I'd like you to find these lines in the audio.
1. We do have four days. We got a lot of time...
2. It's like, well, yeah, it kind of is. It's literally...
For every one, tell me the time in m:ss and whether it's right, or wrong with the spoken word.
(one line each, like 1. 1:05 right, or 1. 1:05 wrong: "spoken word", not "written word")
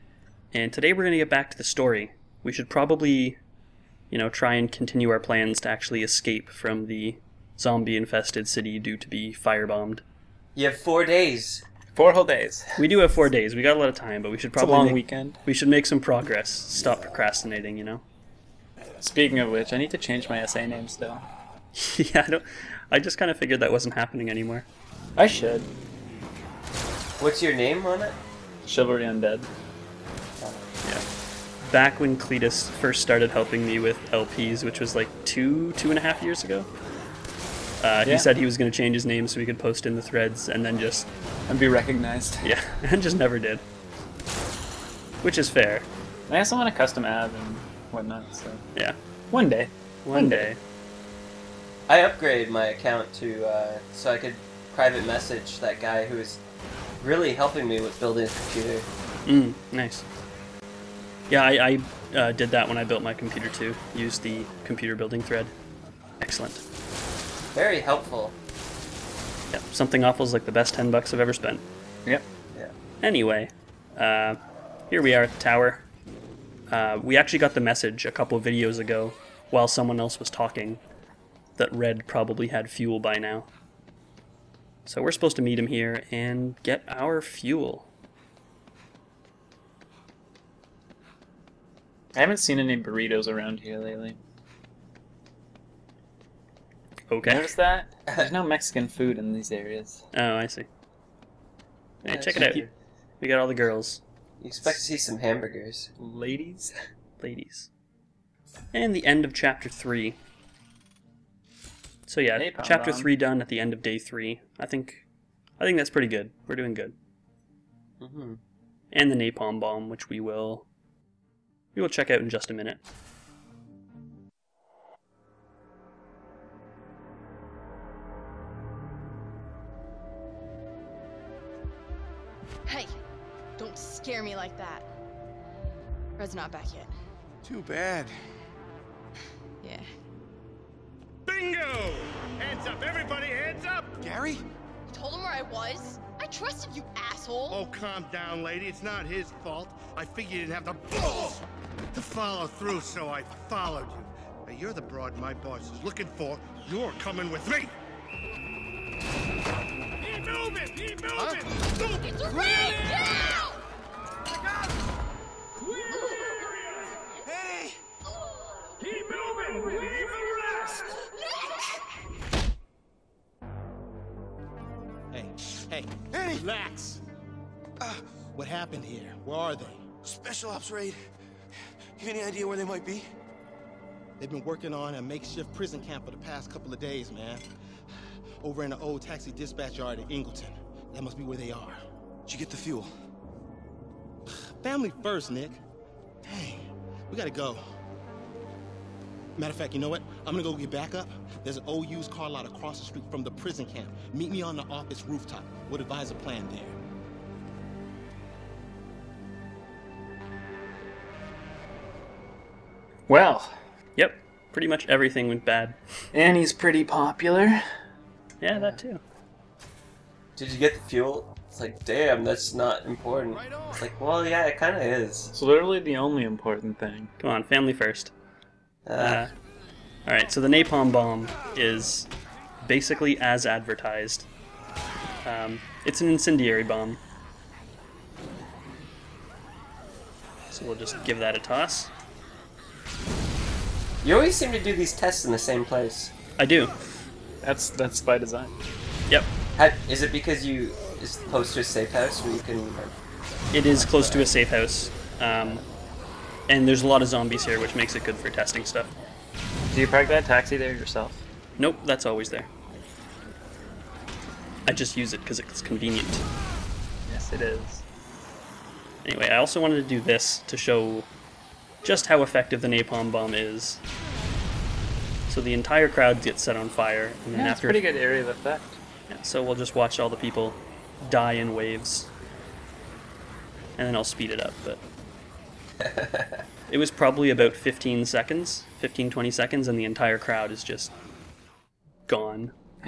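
1. 0:12 right
2. 3:43 right.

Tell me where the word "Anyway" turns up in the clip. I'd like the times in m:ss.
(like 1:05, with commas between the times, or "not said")
1:13, 4:29.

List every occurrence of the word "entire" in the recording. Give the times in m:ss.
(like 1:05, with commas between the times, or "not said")
4:35, 4:49.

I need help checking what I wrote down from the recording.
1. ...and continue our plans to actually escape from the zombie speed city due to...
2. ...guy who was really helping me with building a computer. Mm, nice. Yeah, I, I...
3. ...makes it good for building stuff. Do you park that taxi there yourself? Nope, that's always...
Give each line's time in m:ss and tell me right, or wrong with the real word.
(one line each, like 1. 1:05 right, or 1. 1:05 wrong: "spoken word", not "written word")
1. 0:04 wrong: "infested", not "speed"
2. 0:55 right
3. 4:17 wrong: "testing", not "building".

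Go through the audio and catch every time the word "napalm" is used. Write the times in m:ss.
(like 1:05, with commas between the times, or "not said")
1:59, 3:50, 4:32.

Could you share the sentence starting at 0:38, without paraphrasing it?
he said he was going to change his name so he could post in the threads and then just.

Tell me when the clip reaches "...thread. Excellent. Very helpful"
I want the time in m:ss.
1:05.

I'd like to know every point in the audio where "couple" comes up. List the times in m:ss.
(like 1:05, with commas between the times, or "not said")
1:18, 3:06.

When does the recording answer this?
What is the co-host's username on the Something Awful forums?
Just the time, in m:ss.
0:28.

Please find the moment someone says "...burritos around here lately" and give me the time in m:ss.
1:32.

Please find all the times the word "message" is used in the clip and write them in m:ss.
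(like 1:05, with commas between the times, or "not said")
0:55, 1:17.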